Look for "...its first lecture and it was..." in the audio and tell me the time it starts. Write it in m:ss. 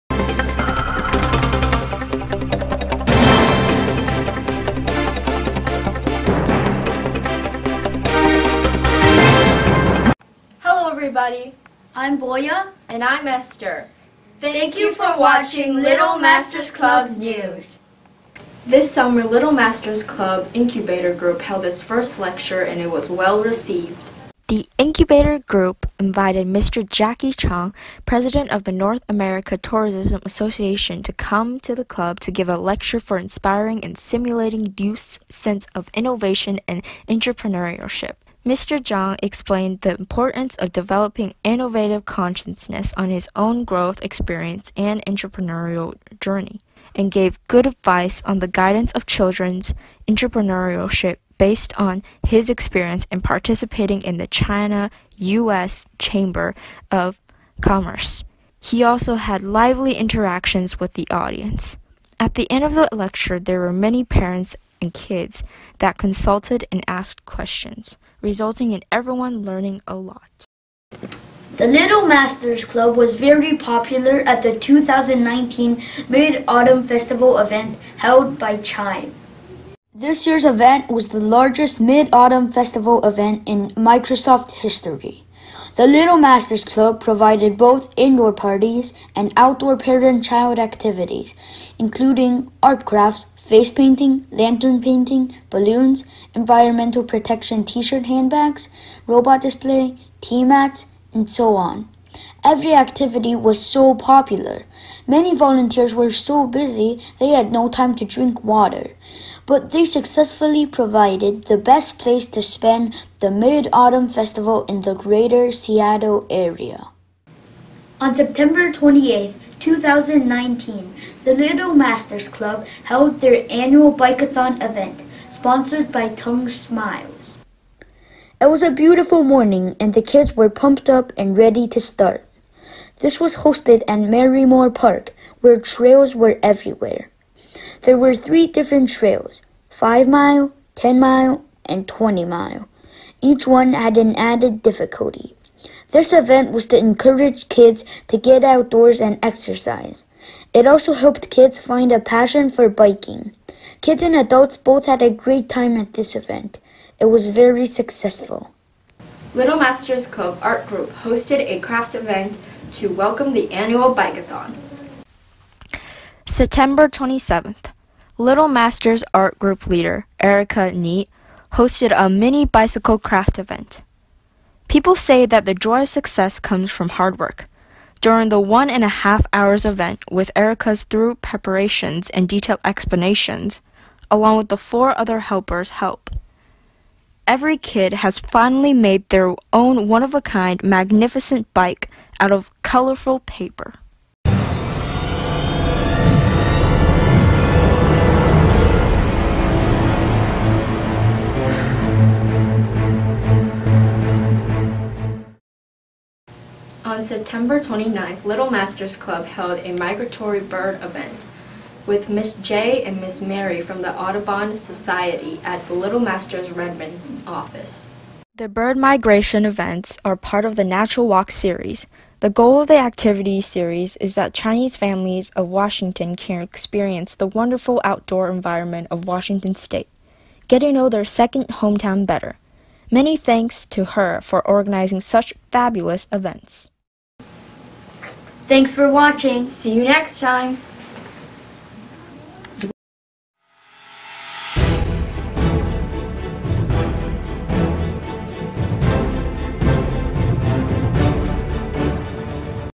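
0:21.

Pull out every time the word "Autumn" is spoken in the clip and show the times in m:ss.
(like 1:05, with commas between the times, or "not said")
1:16, 1:22, 1:53.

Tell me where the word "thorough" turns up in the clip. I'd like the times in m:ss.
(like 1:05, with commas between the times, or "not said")
3:00.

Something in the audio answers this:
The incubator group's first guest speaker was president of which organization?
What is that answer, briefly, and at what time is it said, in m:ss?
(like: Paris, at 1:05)
North America Tourism Association, at 0:28.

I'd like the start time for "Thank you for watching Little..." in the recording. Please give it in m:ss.
0:14.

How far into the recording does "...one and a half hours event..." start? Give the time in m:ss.
2:58.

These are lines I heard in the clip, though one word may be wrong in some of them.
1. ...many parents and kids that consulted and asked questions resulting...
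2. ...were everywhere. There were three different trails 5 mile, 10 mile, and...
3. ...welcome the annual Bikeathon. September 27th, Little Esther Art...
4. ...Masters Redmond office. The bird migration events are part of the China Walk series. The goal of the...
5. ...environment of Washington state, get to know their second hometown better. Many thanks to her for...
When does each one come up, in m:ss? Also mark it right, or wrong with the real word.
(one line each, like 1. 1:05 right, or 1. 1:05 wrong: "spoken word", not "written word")
1. 1:03 right
2. 2:16 right
3. 2:42 wrong: "Masters", not "Esther"
4. 3:35 wrong: "Natural", not "China"
5. 3:48 right.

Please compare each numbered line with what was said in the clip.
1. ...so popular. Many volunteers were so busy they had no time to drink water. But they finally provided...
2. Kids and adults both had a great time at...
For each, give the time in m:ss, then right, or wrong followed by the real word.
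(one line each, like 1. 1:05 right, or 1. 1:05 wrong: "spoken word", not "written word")
1. 1:43 wrong: "successfully", not "finally"
2. 2:33 right.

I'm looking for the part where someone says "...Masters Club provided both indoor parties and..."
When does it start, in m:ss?
1:26.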